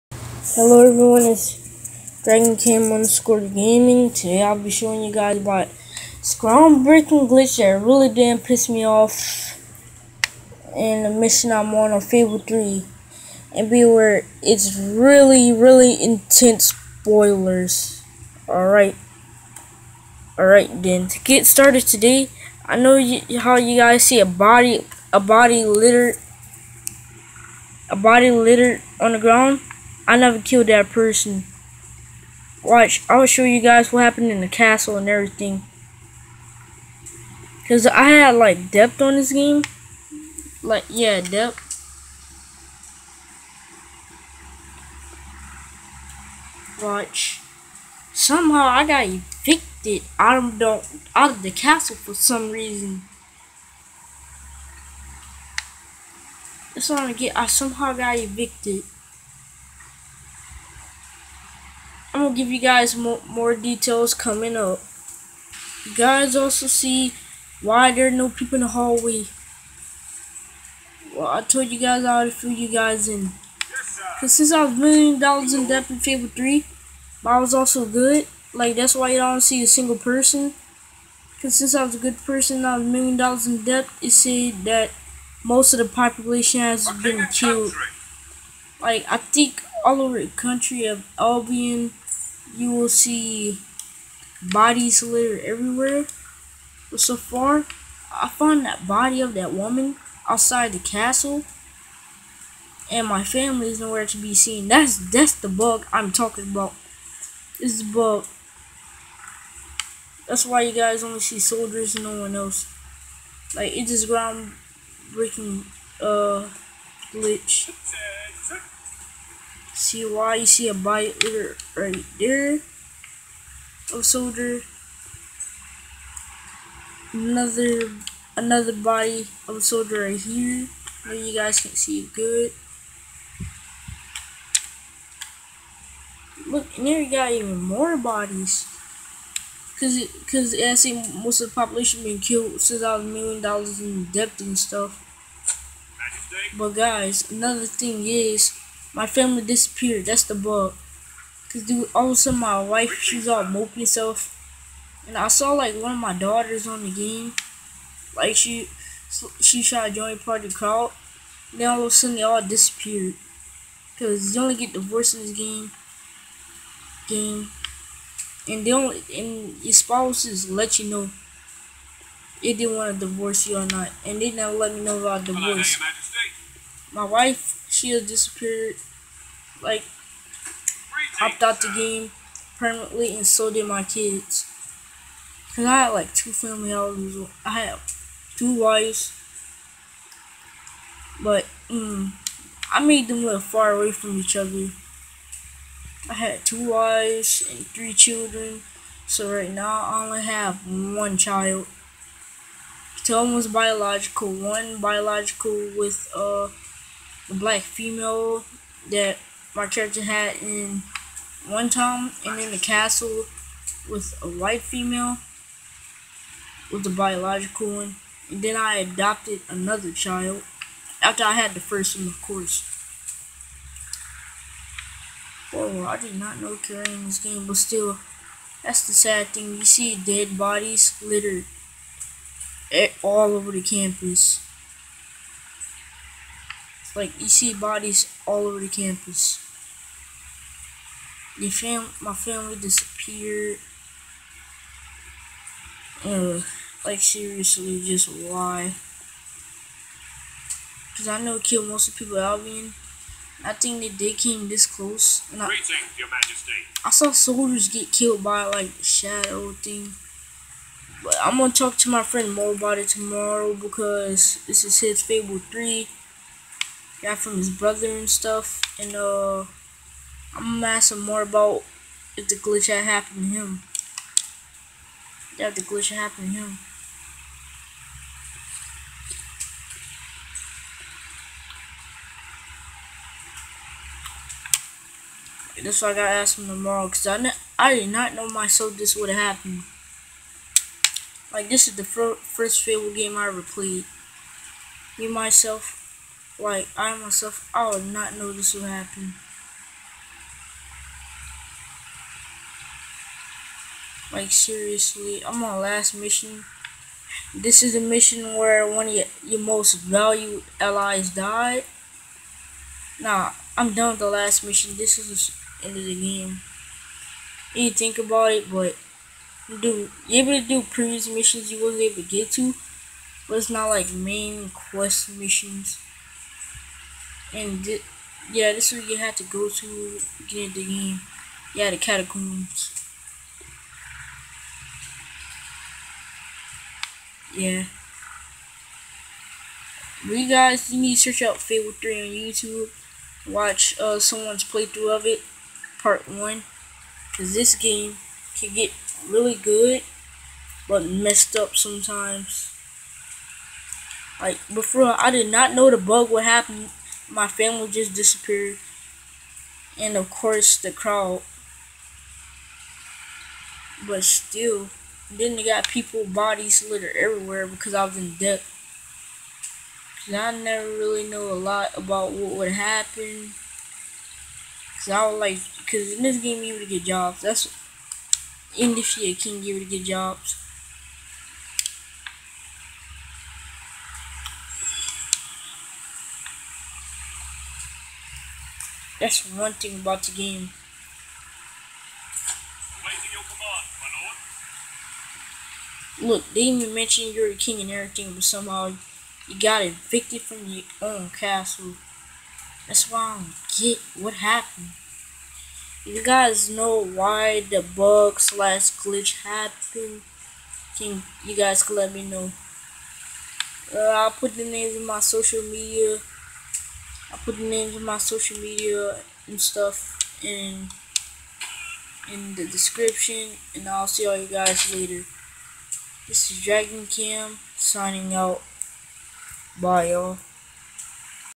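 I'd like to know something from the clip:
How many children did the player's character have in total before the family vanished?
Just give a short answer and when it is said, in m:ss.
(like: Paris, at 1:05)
3, at 3:17.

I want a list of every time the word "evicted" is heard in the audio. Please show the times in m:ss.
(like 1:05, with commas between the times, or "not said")
0:49, 0:58, 6:39.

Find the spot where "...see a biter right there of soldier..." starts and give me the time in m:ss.
2:00.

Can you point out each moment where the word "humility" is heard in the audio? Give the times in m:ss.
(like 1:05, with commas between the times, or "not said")
not said.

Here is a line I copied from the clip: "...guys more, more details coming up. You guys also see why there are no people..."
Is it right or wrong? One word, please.
right.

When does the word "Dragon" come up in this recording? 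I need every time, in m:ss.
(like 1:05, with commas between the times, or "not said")
0:02, 7:06.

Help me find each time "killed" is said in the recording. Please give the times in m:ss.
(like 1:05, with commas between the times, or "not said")
0:30, 1:27, 2:22, 4:11, 4:17.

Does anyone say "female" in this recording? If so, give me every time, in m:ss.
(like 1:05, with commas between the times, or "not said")
3:27, 3:34.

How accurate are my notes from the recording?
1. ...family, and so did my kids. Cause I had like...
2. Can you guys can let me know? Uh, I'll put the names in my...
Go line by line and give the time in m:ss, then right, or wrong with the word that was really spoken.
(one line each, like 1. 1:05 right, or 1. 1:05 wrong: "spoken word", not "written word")
1. 3:02 wrong: "permanently", not "family"
2. 6:50 right.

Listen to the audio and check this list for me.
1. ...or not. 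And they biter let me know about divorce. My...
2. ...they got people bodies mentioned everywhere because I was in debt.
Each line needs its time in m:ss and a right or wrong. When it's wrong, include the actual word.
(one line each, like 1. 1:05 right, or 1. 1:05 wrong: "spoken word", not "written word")
1. 2:53 wrong: "never", not "biter"
2. 6:05 wrong: "littered", not "mentioned".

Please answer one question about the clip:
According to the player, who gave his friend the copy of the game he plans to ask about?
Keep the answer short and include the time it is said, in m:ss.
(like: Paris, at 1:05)
his brother, at 4:27.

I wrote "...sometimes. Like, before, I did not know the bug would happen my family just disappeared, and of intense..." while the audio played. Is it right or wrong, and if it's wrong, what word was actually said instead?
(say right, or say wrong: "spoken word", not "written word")
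wrong: "course", not "intense".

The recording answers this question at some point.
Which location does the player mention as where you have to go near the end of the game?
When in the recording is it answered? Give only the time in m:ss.
5:31.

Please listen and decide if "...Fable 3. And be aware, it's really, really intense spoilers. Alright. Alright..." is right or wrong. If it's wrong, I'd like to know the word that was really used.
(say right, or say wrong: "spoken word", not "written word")
right.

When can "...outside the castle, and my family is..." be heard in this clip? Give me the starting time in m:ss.
1:40.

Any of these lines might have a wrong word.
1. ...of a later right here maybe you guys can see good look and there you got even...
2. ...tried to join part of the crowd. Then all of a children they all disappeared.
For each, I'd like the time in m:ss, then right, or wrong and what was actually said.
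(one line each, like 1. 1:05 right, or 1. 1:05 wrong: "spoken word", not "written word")
1. 2:09 wrong: "soldier", not "later"
2. 2:39 wrong: "sudden", not "children".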